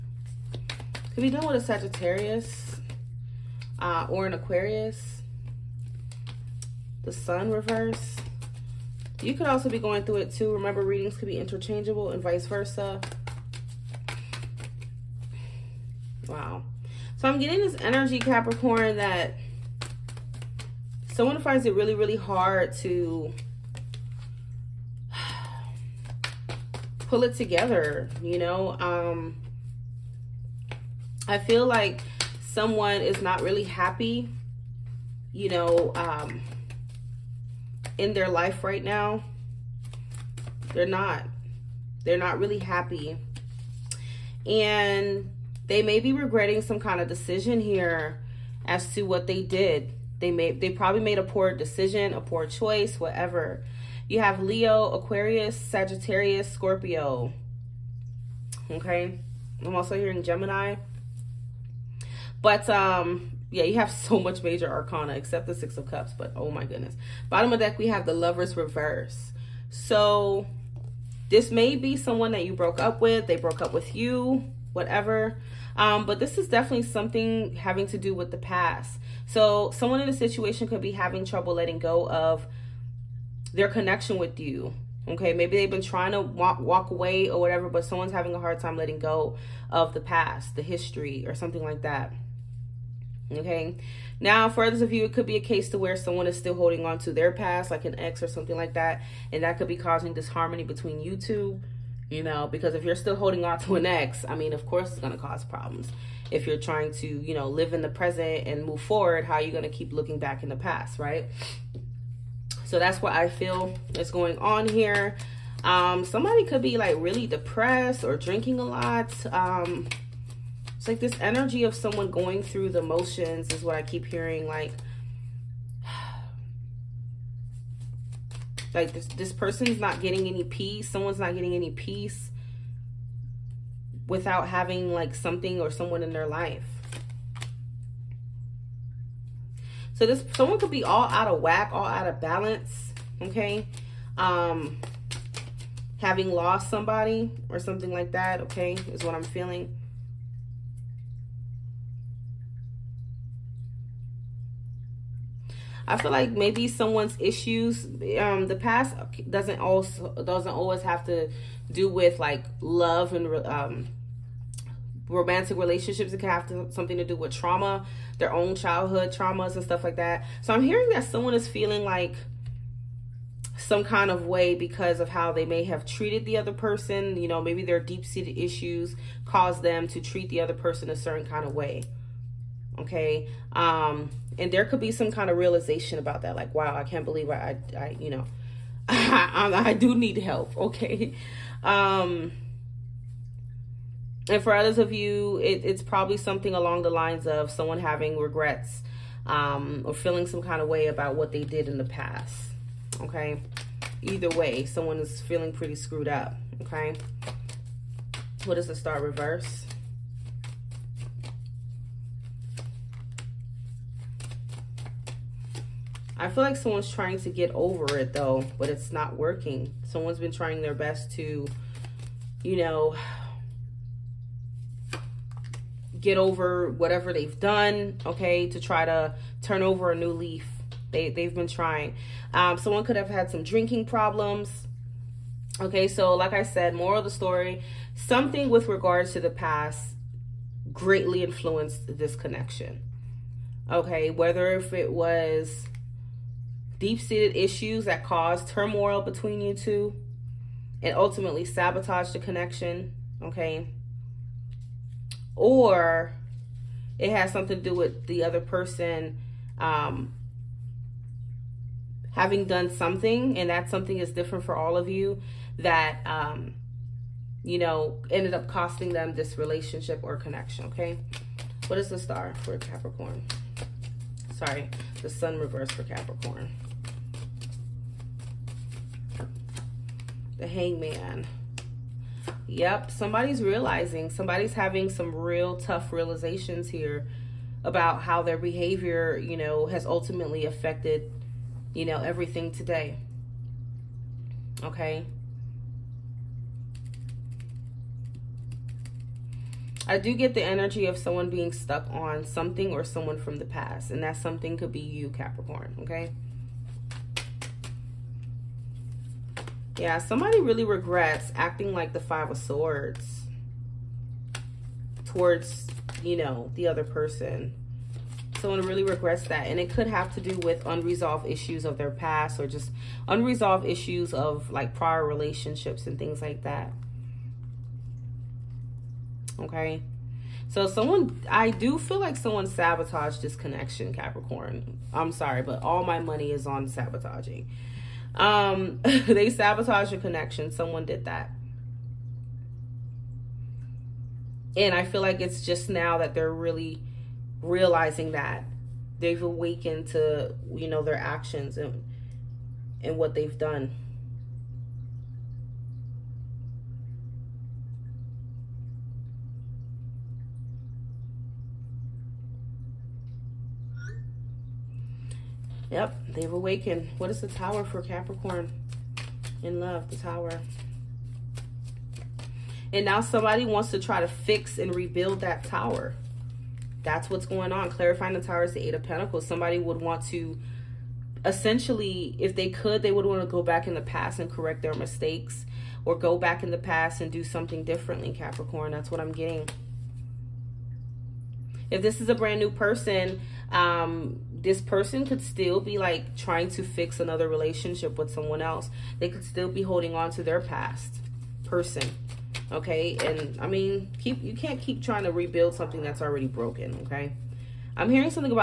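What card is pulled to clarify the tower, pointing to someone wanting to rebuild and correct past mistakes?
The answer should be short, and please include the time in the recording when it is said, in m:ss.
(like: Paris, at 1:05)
Eight of Pentacles, at 6:18.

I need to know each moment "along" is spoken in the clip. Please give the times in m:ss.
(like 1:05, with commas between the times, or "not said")
3:16.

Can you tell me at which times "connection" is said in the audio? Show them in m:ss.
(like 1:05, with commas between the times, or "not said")
1:23, 4:02, 4:12, 4:30, 5:33, 5:40.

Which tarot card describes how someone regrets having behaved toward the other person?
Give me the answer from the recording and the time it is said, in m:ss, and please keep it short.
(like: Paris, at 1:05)
Five of Swords, at 5:12.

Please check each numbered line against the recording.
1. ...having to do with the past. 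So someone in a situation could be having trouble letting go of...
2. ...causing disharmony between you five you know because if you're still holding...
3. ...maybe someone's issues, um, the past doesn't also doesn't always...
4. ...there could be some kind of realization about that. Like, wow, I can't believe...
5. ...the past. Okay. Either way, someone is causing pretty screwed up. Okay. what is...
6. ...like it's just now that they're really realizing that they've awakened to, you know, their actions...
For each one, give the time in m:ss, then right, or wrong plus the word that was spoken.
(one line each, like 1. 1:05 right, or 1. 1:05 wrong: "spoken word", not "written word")
1. 1:17 right
2. 1:39 wrong: "two", not "five"
3. 2:36 right
4. 3:04 right
5. 3:21 wrong: "feeling", not "causing"
6. 5:45 right.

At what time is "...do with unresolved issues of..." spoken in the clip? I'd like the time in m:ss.
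5:20.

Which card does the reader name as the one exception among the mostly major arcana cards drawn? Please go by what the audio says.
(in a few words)
Six of Cups.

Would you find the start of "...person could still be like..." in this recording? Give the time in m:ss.
6:34.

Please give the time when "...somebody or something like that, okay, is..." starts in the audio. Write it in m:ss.
2:26.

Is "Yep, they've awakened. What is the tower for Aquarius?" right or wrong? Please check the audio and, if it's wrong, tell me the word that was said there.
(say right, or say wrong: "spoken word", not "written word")
wrong: "Capricorn", not "Aquarius".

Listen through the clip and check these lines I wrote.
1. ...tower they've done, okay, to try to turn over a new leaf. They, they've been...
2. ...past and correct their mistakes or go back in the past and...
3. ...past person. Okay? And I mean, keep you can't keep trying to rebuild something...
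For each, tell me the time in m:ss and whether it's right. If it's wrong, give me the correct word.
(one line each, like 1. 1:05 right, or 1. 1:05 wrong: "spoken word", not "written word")
1. 3:46 wrong: "whatever", not "tower"
2. 6:23 right
3. 6:40 right.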